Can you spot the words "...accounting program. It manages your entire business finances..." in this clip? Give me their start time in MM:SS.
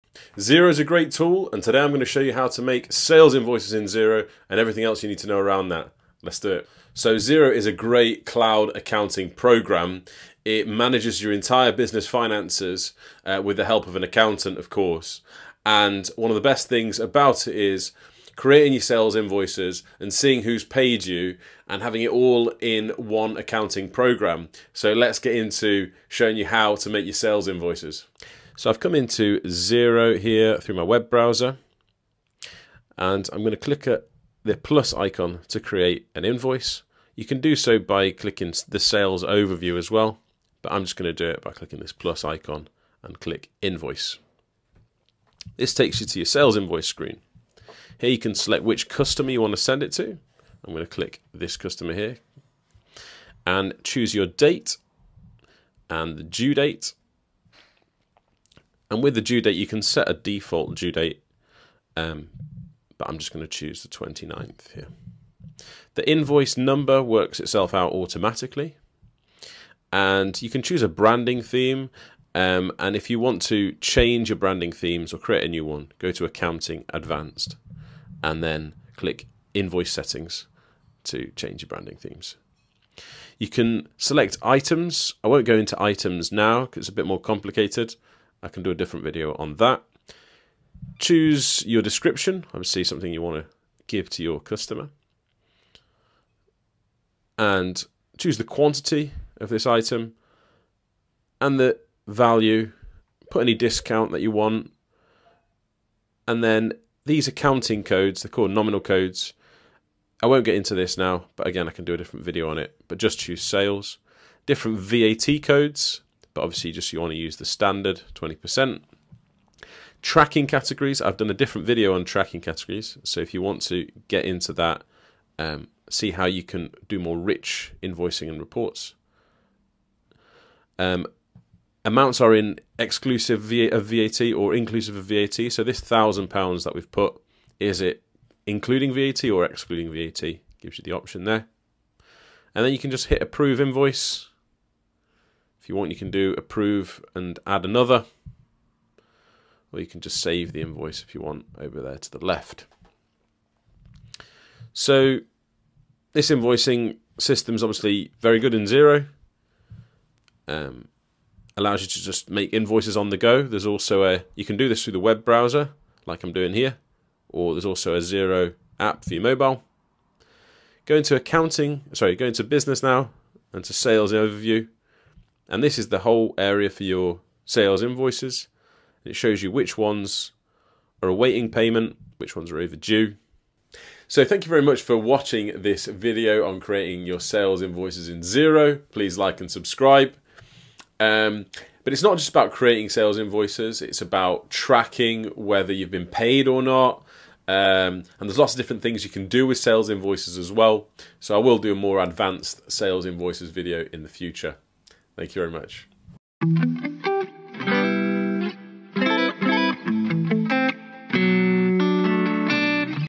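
00:08.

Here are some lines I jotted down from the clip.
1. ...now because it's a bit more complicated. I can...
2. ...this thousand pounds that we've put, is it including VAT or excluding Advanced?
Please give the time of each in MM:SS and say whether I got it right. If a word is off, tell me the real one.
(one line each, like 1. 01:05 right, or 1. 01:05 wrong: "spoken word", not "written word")
1. 01:26 right
2. 02:15 wrong: "VAT", not "Advanced".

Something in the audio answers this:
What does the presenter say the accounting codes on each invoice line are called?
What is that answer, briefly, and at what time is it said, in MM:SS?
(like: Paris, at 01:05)
nominal codes, at 01:48.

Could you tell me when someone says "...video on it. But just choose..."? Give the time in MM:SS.
01:52.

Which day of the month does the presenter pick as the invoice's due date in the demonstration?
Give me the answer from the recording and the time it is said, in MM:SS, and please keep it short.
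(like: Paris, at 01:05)
29th, at 01:03.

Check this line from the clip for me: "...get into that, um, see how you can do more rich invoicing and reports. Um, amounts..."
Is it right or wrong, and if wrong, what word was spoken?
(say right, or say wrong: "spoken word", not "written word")
right.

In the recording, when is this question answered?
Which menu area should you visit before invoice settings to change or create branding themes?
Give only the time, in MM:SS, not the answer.
01:16.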